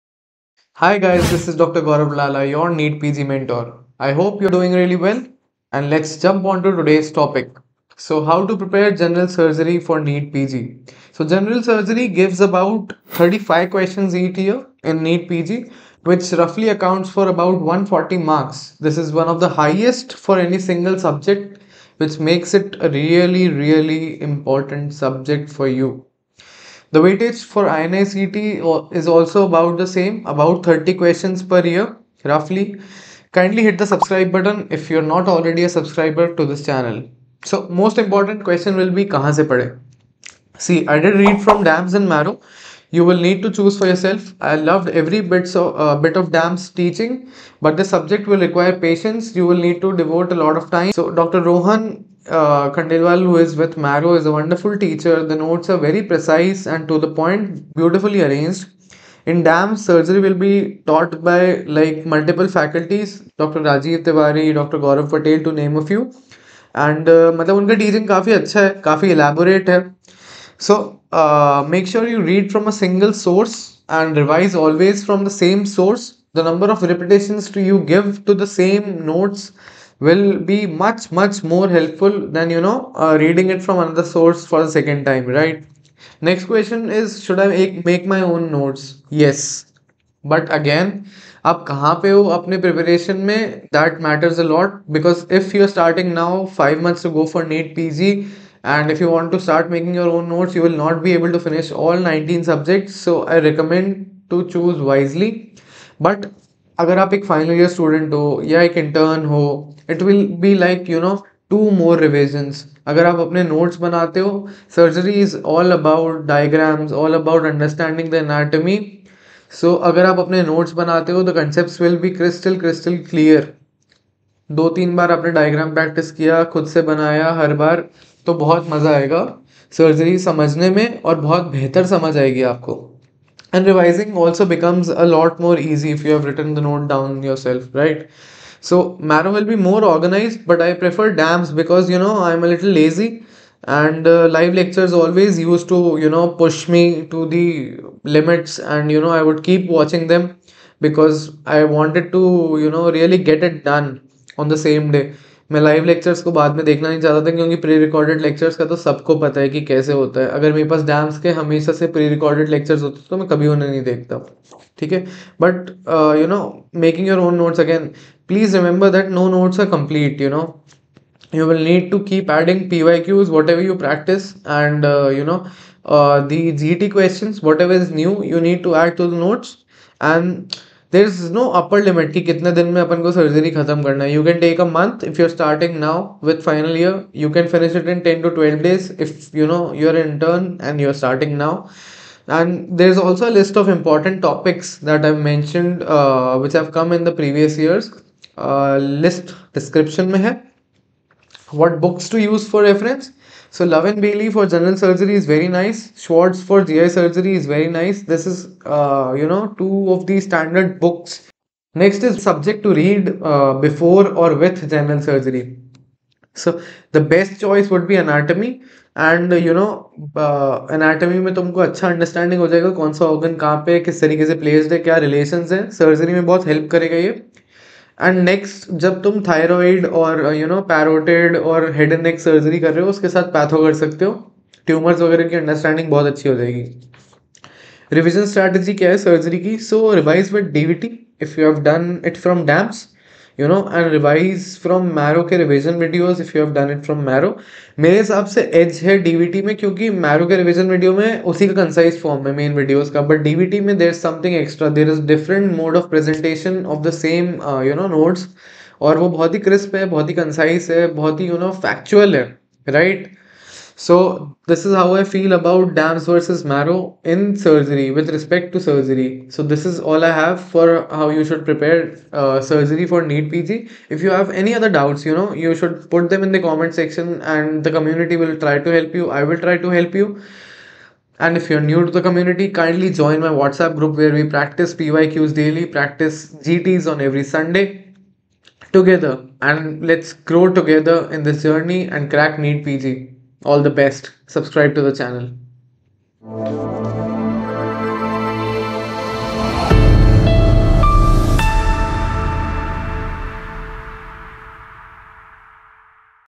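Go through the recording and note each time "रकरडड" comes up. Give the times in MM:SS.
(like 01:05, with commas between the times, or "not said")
02:37, 02:42.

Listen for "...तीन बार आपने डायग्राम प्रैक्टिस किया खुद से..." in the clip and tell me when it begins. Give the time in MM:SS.
02:04.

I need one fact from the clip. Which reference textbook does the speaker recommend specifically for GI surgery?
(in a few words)
Schwartz.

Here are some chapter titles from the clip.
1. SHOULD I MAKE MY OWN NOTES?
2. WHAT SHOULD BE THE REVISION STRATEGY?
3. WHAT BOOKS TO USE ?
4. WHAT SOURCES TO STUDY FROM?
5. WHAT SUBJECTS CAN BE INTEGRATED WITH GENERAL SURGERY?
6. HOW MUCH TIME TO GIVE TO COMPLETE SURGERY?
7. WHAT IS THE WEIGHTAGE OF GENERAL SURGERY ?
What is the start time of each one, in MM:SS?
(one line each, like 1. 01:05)
1. 01:27
2. 03:57
3. 03:22
4. 00:40
5. 03:33
6. 03:00
7. 00:16.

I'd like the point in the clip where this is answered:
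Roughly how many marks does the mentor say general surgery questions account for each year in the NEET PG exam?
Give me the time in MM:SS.
00:17.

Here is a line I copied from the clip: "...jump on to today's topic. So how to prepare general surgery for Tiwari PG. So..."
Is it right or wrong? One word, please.
wrong.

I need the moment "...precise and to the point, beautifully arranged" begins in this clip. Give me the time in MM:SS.
00:56.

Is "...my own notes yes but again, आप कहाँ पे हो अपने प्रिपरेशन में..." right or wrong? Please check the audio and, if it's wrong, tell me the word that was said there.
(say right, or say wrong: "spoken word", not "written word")
right.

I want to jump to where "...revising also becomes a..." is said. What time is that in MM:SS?
02:13.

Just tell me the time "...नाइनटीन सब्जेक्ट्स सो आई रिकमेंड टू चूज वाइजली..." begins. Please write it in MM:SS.
01:42.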